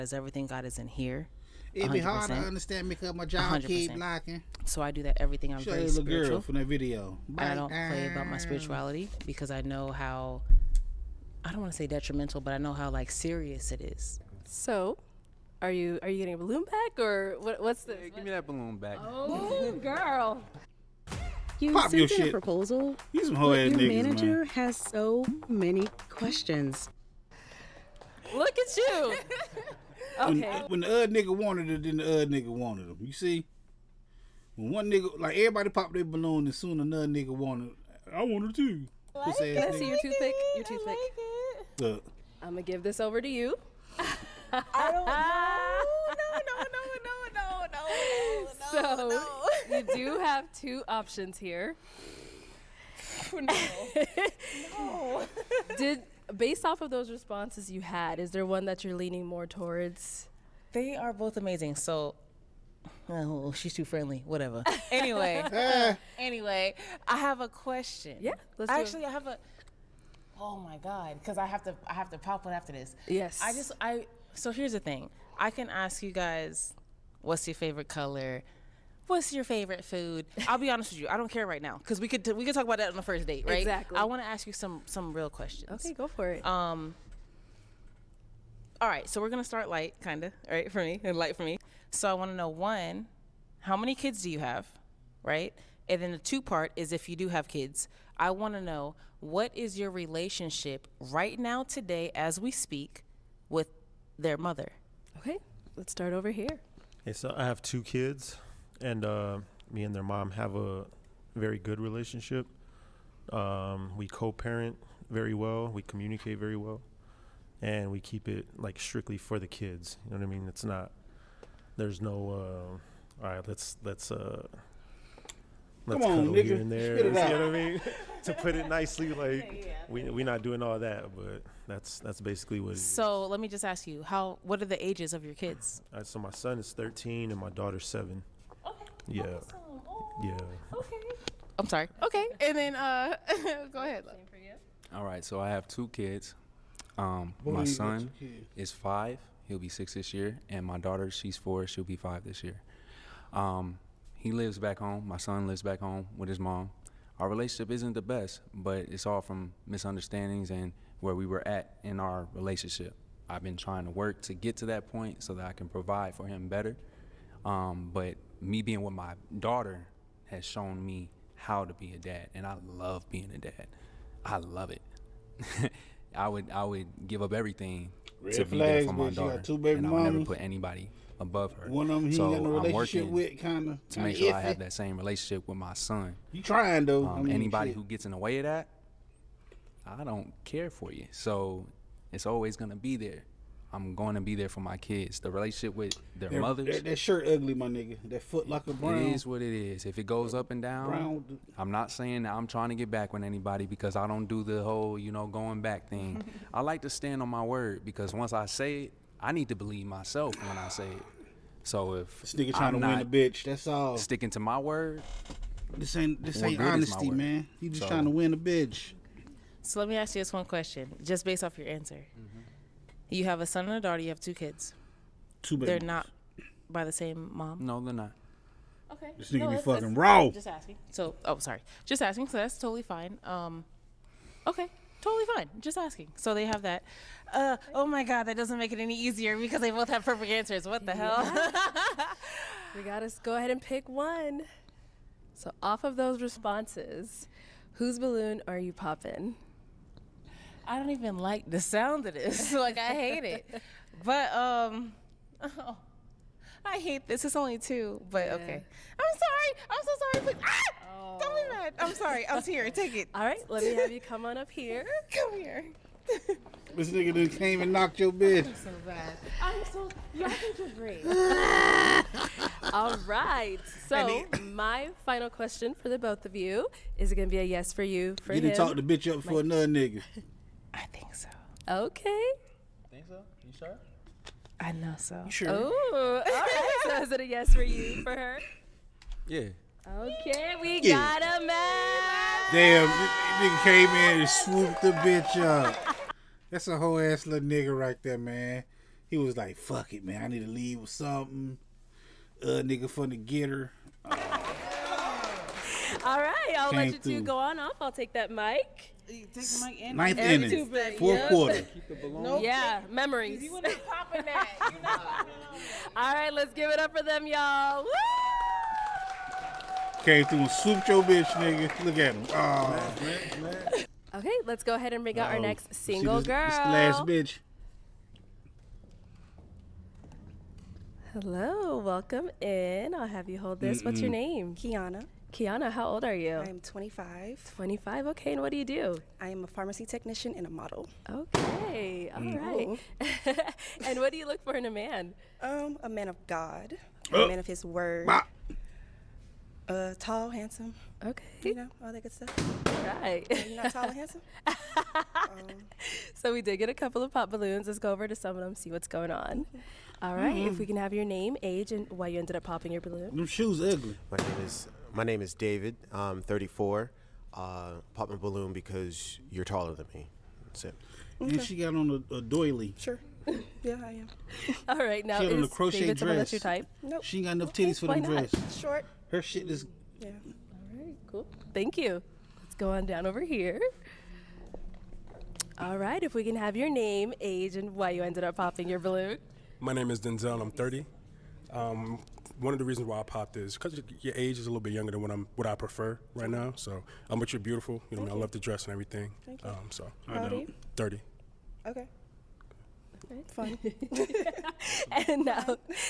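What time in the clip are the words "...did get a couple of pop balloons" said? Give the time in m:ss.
5:56.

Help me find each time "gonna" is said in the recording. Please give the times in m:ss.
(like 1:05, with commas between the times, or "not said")
0:42, 1:29, 3:12, 4:37.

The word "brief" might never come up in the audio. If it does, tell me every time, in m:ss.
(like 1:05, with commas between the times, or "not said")
not said.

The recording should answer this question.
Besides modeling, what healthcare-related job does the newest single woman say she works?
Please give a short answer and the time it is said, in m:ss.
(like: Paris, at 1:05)
Pharmacy technician, at 5:39.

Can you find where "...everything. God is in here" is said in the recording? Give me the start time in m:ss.
0:00.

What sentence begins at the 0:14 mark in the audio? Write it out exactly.
So are you are you getting a balloon back or what, what's the?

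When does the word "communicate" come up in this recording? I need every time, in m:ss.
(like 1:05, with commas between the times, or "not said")
1:55.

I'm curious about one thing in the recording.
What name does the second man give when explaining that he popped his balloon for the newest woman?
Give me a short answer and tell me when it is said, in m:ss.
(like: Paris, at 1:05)
Denzel, at 6:30.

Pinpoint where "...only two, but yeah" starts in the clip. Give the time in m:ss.
4:17.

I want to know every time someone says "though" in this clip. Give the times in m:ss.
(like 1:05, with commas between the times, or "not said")
3:06.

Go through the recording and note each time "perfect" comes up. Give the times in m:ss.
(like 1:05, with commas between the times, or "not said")
4:00.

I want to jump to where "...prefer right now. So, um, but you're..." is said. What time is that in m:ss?
6:35.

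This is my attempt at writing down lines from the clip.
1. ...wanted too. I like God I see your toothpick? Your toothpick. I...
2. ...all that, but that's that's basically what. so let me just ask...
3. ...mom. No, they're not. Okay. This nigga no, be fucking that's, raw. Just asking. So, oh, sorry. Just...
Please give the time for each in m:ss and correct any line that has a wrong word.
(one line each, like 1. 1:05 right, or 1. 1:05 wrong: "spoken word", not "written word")
1. 0:38 wrong: "Can", not "God"
2. 2:10 right
3. 3:47 right.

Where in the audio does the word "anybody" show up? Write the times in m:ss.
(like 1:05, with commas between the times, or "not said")
3:00, 3:07, 3:23.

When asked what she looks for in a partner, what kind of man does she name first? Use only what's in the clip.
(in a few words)
A man of God.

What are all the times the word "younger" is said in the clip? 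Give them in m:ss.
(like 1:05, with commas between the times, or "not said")
6:34.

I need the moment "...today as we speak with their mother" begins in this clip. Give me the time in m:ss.
1:41.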